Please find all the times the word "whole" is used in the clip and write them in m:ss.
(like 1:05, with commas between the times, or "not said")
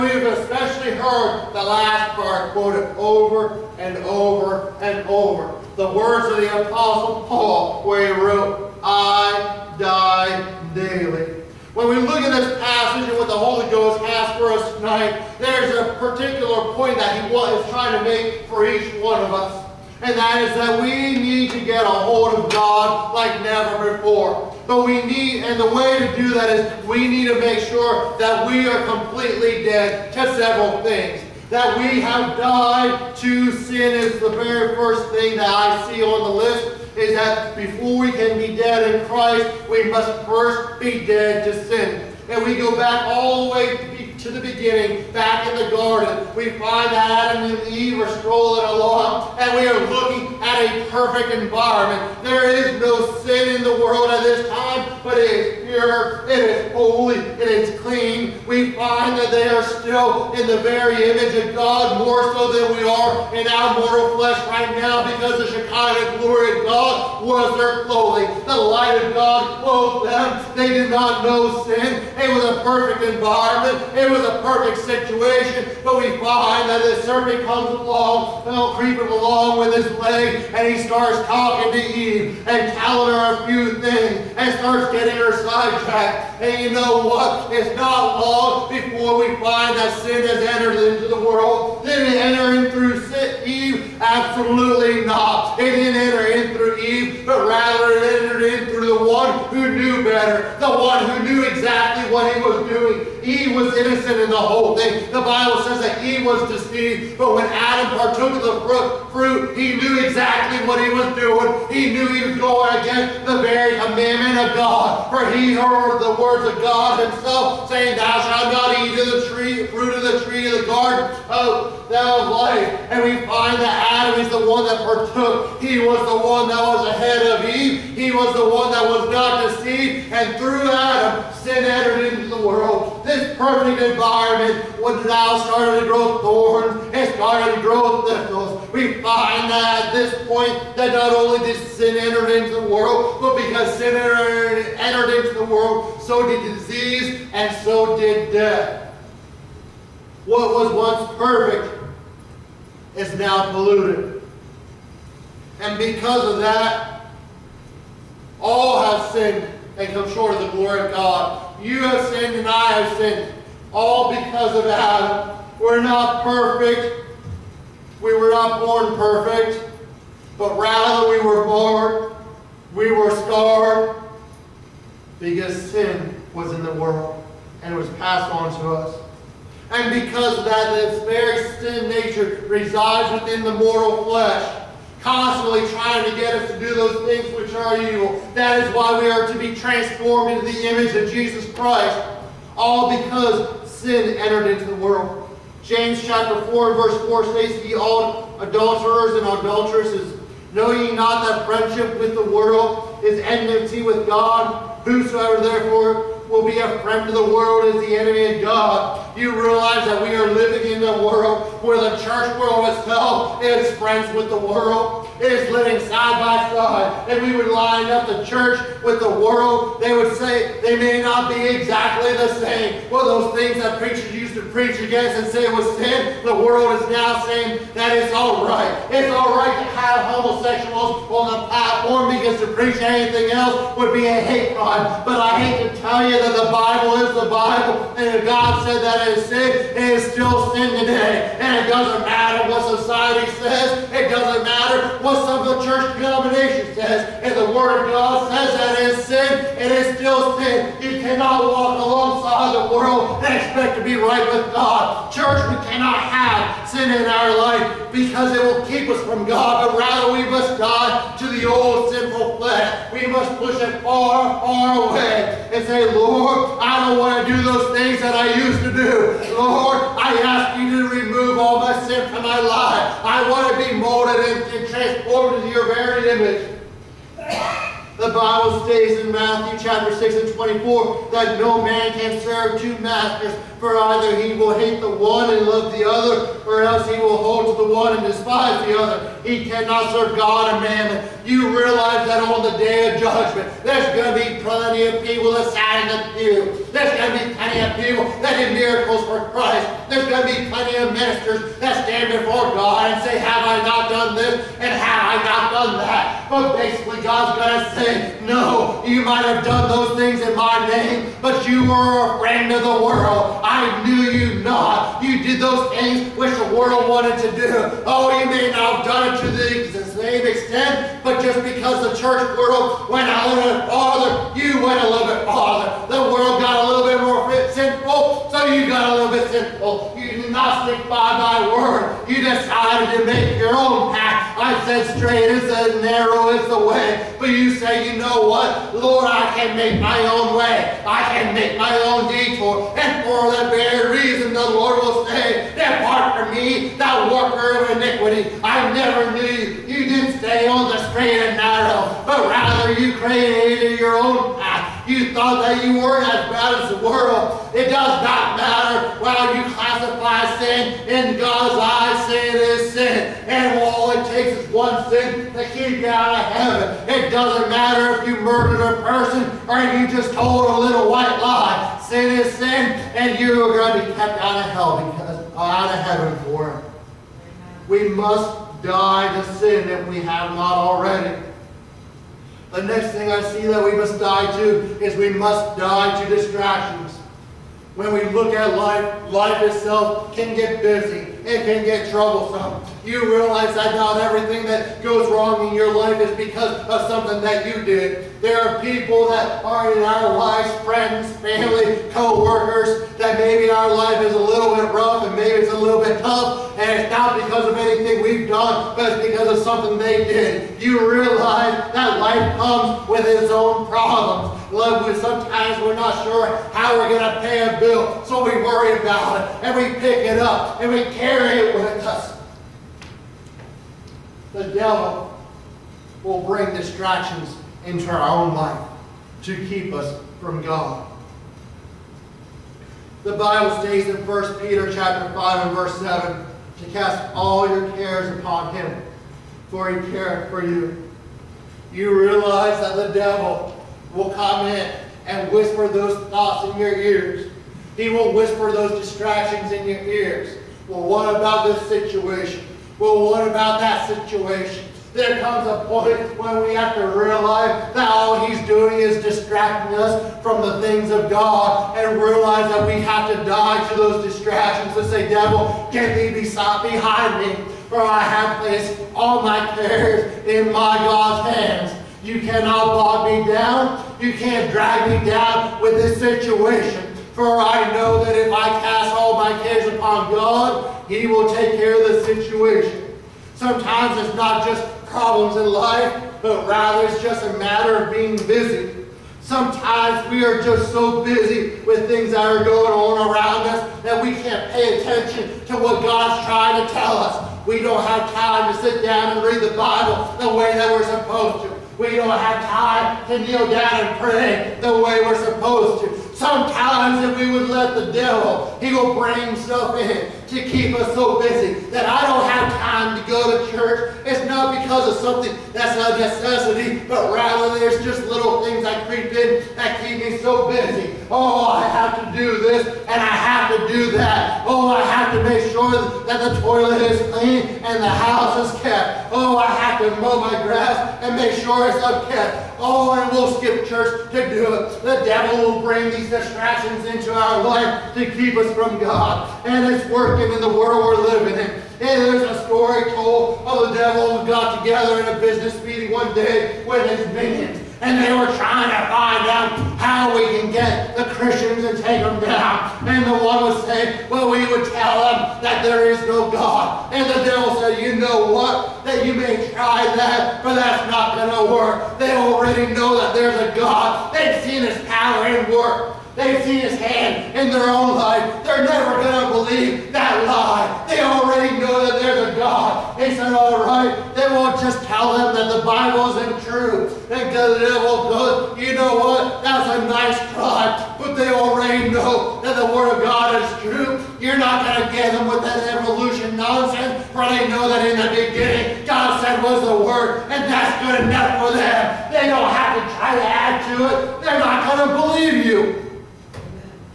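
1:44.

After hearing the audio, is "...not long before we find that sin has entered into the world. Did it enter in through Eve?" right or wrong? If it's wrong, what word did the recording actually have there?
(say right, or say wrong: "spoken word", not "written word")
right.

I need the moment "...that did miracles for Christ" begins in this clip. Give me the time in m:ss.
4:58.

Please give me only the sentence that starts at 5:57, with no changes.
It does not matter how you classify sin.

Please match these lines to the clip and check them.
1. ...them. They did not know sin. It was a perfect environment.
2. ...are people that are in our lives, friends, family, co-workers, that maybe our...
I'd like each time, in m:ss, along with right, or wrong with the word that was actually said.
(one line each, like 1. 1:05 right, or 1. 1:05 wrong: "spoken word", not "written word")
1. 1:10 right
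2. 6:38 right.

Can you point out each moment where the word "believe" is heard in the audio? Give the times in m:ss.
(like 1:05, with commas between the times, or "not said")
9:29, 9:54.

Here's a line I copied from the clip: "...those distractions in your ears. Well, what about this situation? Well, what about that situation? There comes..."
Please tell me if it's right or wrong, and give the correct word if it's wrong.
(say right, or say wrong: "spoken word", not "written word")
right.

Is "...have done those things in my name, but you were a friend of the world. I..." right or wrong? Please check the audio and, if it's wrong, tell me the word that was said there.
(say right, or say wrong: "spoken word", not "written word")
right.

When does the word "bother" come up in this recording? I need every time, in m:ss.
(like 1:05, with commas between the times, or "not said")
not said.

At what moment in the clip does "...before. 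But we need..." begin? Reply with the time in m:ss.
0:23.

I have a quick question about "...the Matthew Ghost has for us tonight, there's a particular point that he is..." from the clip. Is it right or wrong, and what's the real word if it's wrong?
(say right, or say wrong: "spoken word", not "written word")
wrong: "Holy", not "Matthew".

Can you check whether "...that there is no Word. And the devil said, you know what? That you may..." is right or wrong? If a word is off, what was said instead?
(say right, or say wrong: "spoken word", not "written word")
wrong: "God", not "Word".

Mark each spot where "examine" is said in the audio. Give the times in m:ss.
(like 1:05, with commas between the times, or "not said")
not said.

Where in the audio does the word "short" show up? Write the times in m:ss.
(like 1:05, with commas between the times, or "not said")
2:40.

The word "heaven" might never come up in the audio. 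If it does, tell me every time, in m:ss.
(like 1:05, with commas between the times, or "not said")
6:06, 6:15.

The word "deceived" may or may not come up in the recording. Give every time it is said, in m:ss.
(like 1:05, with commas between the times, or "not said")
1:46, 2:09.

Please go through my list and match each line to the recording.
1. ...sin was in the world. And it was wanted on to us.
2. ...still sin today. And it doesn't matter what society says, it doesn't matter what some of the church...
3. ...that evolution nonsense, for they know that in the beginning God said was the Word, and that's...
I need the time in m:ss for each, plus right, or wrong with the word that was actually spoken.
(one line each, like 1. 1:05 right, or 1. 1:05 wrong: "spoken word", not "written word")
1. 2:55 wrong: "passed", not "wanted"
2. 4:00 right
3. 9:45 right.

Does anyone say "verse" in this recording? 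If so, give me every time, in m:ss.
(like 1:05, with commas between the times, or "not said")
3:16, 7:15.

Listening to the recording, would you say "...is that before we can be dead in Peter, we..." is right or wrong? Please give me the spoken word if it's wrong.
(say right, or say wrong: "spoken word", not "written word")
wrong: "Christ", not "Peter".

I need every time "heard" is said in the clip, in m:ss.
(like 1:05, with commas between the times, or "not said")
0:00, 1:55.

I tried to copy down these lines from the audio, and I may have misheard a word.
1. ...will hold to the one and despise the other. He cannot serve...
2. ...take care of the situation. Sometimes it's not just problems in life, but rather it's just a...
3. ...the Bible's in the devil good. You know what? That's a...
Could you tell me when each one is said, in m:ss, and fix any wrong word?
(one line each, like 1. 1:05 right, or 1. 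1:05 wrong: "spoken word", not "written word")
1. 4:46 right
2. 8:01 right
3. 9:35 right.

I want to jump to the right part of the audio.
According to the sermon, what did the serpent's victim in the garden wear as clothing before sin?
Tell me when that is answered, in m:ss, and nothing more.
1:05.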